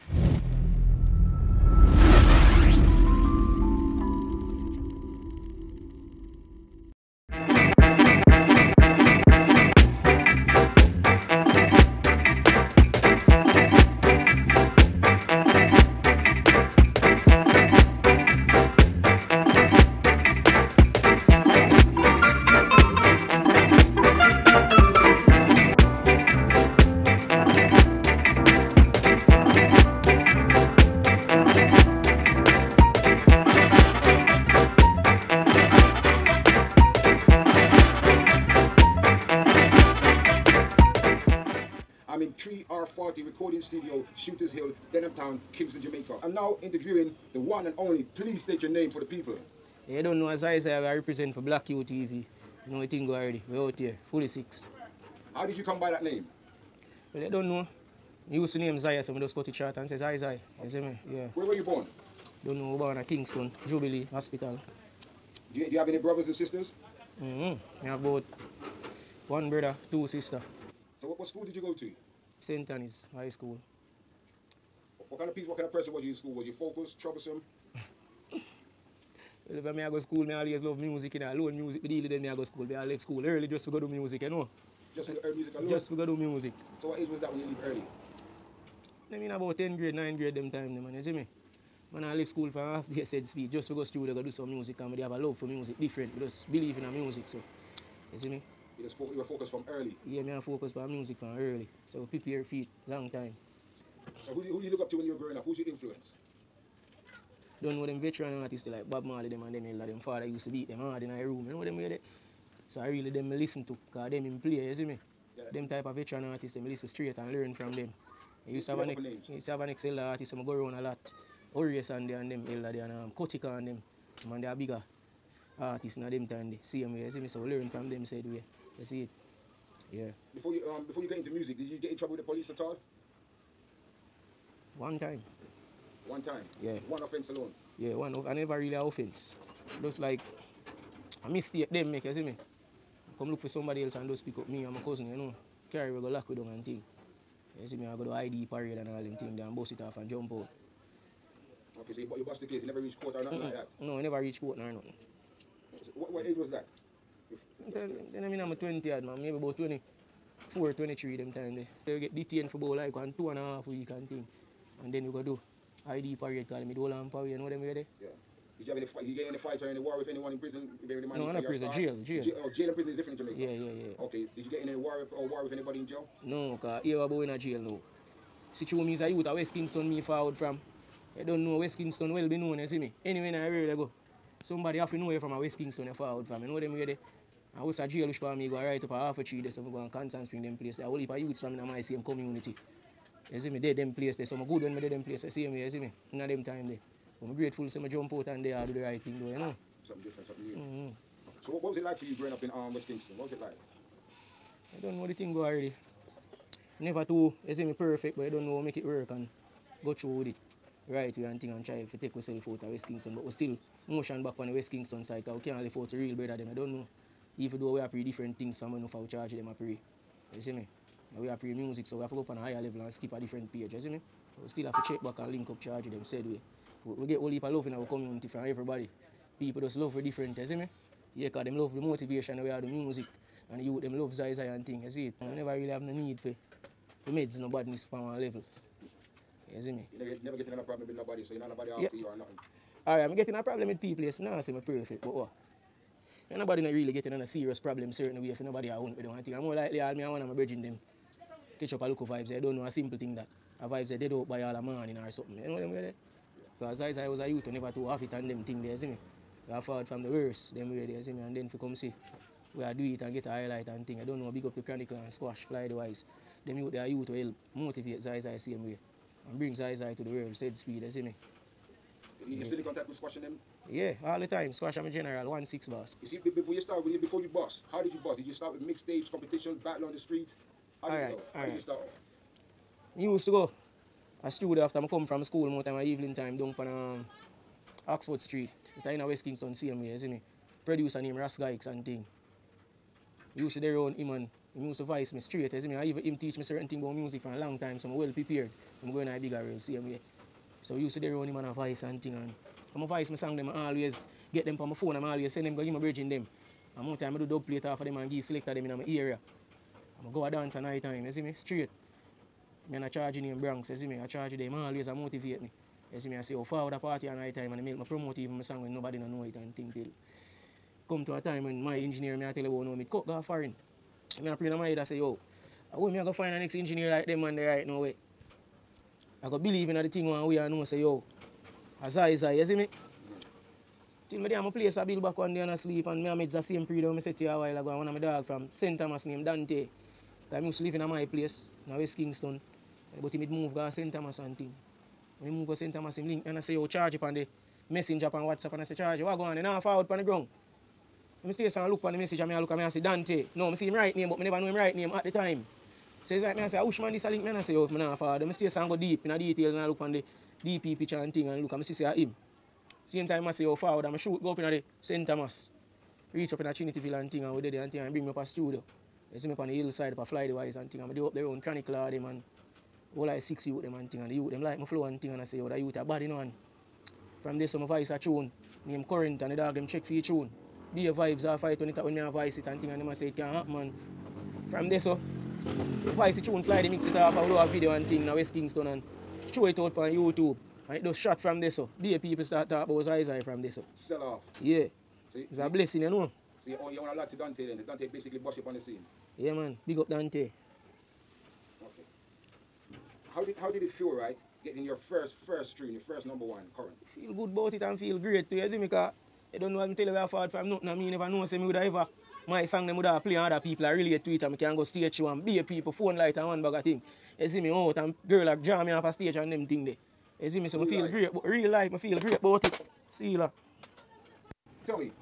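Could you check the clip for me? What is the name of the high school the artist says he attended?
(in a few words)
St. Annie's High School.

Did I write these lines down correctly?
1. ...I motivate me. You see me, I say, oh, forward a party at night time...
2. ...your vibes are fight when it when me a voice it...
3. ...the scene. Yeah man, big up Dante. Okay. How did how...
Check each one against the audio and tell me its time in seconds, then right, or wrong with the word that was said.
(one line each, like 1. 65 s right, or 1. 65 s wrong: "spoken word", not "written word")
1. 314 s right
2. 380 s right
3. 398 s right.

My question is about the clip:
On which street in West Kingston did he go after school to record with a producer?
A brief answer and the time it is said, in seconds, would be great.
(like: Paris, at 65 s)
Oxford Street, at 287 s.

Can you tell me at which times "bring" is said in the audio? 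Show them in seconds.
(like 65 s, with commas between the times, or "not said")
269 s, 367 s.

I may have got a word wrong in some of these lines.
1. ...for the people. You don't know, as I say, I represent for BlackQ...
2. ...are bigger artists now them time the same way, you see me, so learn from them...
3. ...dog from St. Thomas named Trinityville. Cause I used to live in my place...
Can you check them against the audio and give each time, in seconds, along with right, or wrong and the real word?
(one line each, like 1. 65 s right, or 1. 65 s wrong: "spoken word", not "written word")
1. 48 s right
2. 124 s right
3. 337 s wrong: "Dante", not "Trinityville".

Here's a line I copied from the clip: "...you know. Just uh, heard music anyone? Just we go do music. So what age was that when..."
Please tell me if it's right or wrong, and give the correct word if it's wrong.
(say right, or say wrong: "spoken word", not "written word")
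wrong: "alone", not "anyone".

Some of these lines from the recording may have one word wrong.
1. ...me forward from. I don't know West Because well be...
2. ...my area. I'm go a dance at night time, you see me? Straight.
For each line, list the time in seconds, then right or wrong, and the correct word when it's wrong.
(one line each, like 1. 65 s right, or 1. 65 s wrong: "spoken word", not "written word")
1. 179 s wrong: "Kingston", not "Because"
2. 308 s right.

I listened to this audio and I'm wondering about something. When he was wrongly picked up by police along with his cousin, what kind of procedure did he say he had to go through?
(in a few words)
ID parade.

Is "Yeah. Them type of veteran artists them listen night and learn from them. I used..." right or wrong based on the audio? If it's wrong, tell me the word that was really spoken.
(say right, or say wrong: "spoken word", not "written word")
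wrong: "straight", not "night".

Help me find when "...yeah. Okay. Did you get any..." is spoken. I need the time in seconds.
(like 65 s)
173 s.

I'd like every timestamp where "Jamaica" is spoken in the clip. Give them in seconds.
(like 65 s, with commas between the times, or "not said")
45 s, 173 s.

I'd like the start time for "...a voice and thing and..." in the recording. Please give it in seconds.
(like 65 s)
301 s.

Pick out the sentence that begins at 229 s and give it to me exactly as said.
People just love for different, you see me?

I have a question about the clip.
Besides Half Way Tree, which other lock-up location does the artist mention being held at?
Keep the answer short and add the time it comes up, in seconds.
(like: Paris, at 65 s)
Constant Spring, at 189 s.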